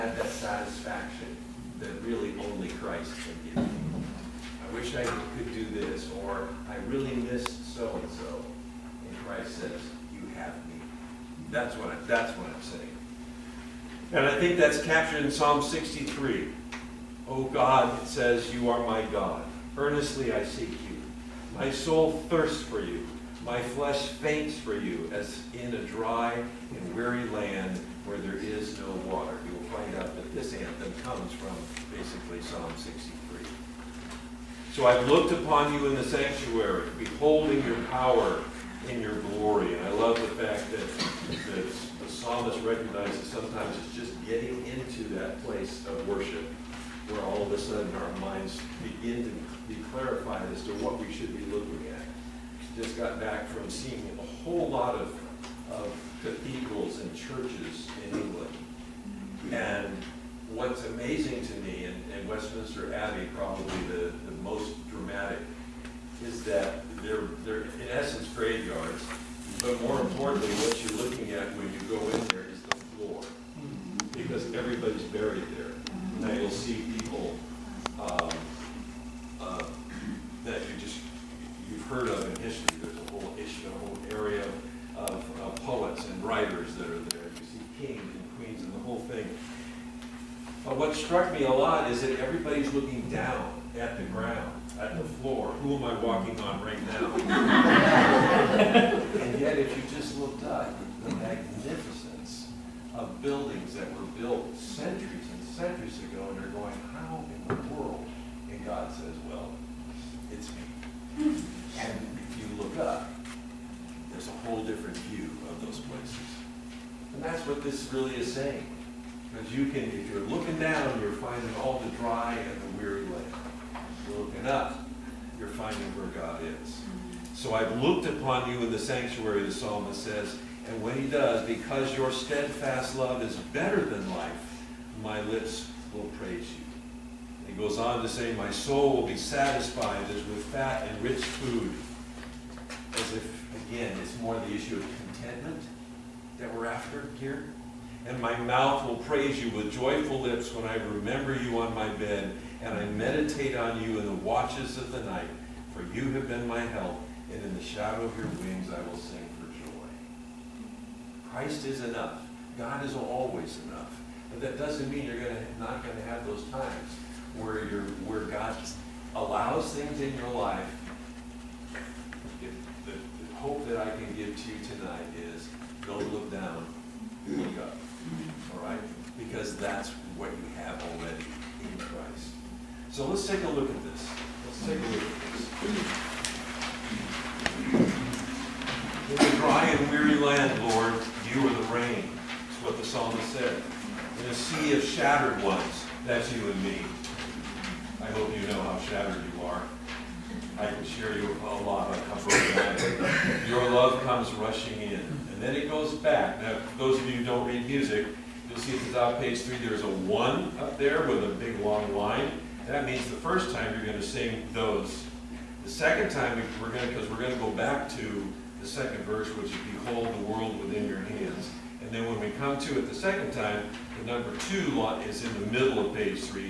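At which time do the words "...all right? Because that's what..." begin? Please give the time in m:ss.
2:58.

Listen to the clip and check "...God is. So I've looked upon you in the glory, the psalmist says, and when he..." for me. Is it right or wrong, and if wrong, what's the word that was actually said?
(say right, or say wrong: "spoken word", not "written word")
wrong: "sanctuary", not "glory".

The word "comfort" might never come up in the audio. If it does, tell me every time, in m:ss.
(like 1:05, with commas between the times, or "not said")
3:22.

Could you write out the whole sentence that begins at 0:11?
That's what, I, that's what I'm saying.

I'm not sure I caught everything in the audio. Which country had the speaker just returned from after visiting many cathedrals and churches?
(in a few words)
England.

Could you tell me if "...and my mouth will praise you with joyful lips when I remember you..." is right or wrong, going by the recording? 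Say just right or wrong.
right.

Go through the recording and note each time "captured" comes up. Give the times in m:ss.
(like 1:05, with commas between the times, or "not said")
0:14.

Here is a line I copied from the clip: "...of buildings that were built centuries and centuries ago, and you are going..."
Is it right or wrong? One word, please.
right.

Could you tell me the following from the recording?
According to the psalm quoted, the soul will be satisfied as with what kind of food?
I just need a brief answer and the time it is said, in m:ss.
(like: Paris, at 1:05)
fat and rich food, at 2:20.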